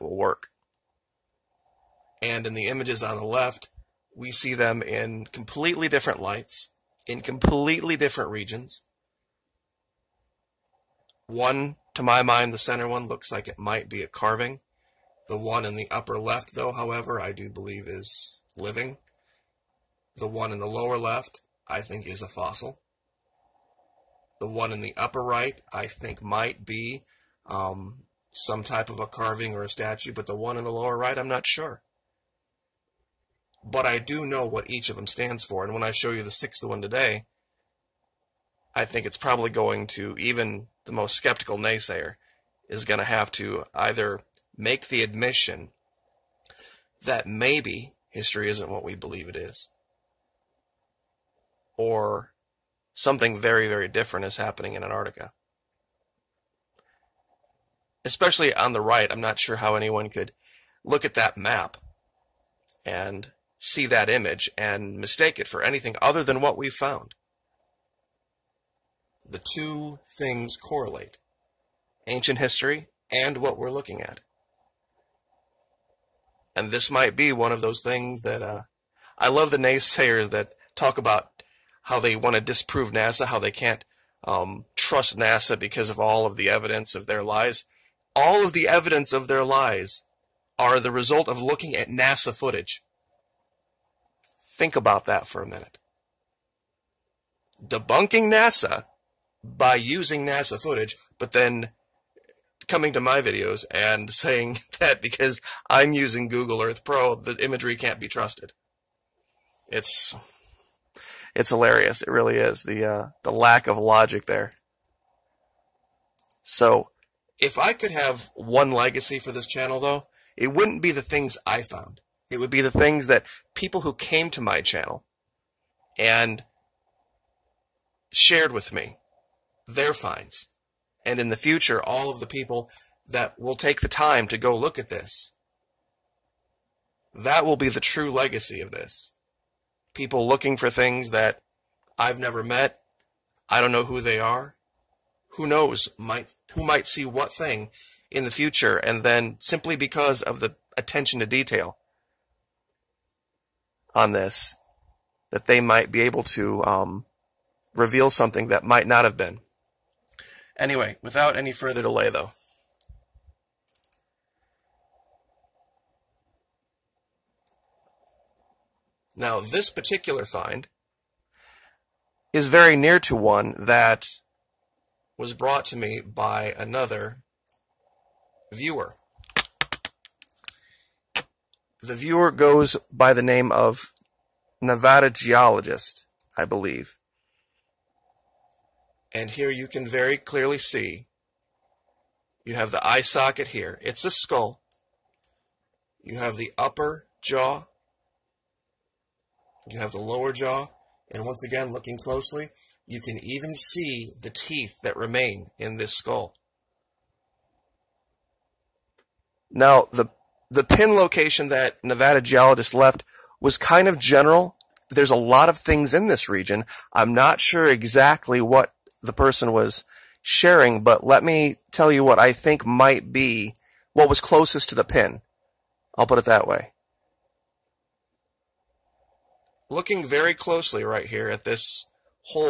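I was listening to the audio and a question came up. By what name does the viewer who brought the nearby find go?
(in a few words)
Nevada Geologist.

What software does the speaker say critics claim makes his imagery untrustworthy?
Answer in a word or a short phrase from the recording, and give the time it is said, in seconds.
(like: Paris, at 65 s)
Google Earth Pro, at 106 s.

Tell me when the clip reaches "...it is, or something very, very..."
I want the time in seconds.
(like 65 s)
49 s.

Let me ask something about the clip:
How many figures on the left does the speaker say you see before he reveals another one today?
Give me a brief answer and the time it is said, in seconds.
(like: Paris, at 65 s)
5, at 36 s.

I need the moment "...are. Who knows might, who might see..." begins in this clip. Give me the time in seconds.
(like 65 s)
144 s.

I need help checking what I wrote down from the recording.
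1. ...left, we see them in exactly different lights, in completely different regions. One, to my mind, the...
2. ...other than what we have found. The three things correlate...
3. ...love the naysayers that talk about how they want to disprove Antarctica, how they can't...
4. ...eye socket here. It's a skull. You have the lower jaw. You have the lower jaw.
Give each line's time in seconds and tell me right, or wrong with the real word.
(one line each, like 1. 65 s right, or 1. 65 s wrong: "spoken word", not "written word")
1. 3 s wrong: "completely", not "exactly"
2. 66 s wrong: "two", not "three"
3. 79 s wrong: "NASA", not "Antarctica"
4. 192 s wrong: "upper", not "lower".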